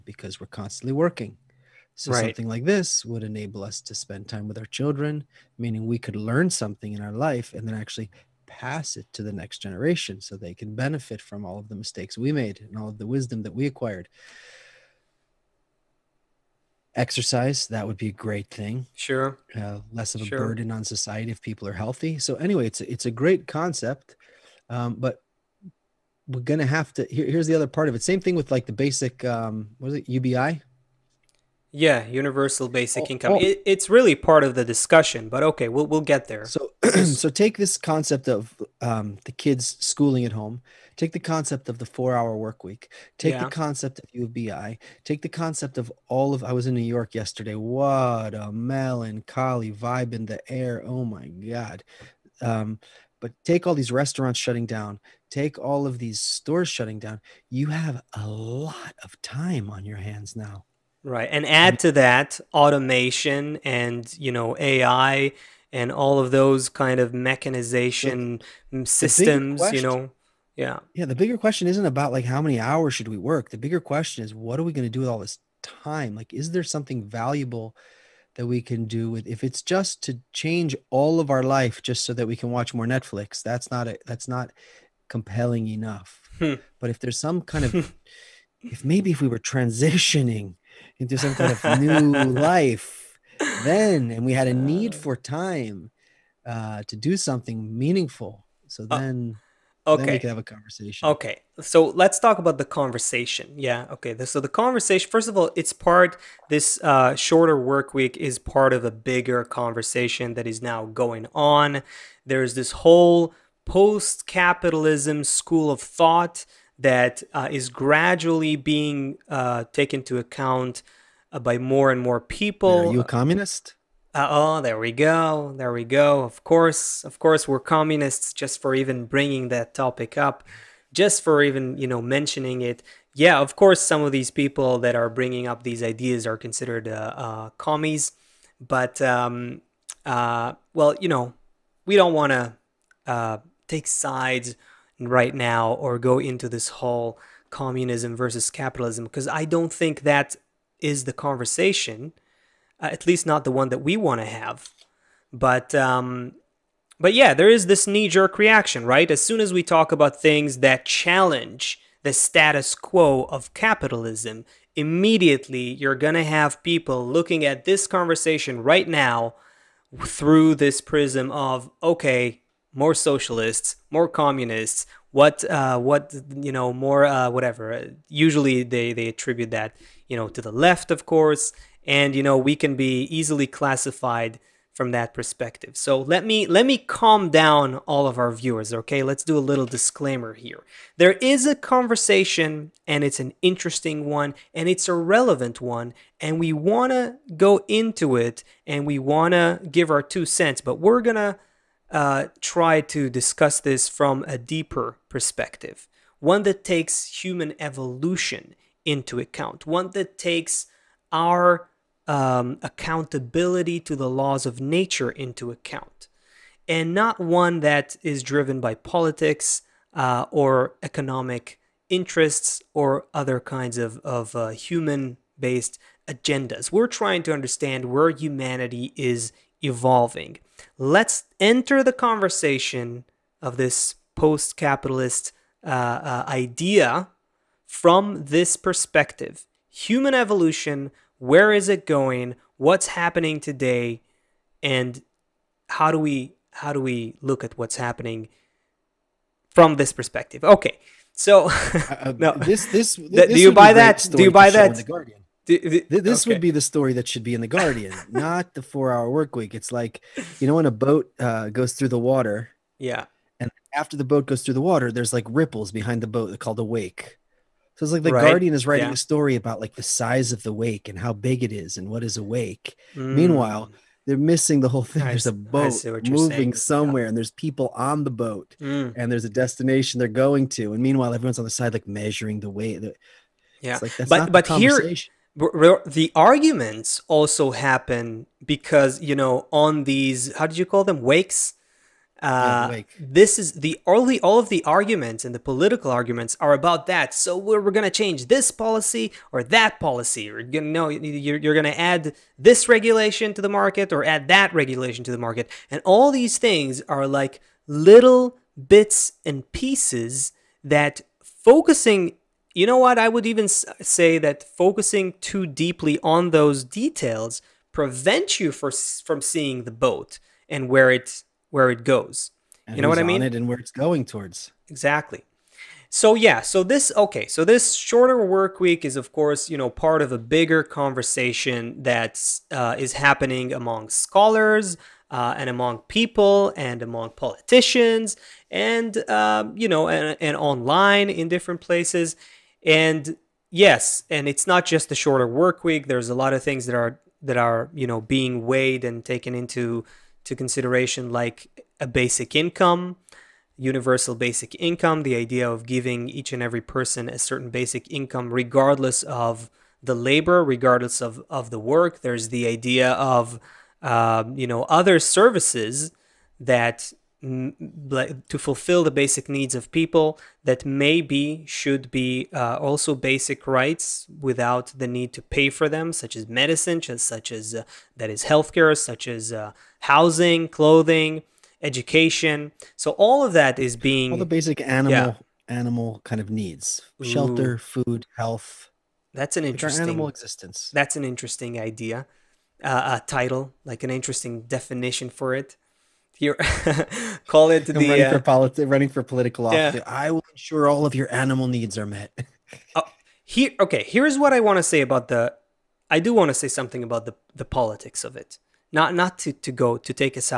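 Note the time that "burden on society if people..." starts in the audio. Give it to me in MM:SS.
00:20.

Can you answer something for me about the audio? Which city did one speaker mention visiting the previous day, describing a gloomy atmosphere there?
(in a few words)
New York.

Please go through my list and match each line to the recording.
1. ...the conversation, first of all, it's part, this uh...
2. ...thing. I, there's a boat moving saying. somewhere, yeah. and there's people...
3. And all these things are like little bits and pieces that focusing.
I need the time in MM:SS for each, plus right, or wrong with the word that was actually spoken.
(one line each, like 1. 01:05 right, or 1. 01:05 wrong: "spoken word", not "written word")
1. 01:44 right
2. 04:34 right
3. 05:05 right.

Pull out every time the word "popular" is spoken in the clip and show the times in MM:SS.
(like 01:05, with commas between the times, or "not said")
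not said.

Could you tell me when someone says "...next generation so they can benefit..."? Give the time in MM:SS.
00:09.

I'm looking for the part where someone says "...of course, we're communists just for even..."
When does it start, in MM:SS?
02:07.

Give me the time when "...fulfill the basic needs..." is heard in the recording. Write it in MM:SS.
06:08.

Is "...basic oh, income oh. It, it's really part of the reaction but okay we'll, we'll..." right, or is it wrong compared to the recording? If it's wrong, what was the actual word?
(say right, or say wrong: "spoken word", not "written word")
wrong: "discussion", not "reaction".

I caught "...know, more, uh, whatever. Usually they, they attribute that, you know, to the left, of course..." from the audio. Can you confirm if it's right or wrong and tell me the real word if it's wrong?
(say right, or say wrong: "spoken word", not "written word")
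right.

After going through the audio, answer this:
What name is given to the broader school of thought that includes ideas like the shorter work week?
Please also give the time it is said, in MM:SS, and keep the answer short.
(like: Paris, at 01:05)
post capitalism, at 01:53.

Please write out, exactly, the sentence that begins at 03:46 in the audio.
We're trying to understand where humanity is evolving.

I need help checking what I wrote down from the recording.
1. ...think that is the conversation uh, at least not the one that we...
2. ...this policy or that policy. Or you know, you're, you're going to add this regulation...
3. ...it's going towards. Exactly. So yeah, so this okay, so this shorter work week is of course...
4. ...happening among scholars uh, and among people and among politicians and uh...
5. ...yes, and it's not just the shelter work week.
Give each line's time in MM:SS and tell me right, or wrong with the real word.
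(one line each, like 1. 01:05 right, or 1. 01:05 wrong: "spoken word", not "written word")
1. 02:29 right
2. 04:58 right
3. 05:23 right
4. 05:32 right
5. 05:43 wrong: "shorter", not "shelter".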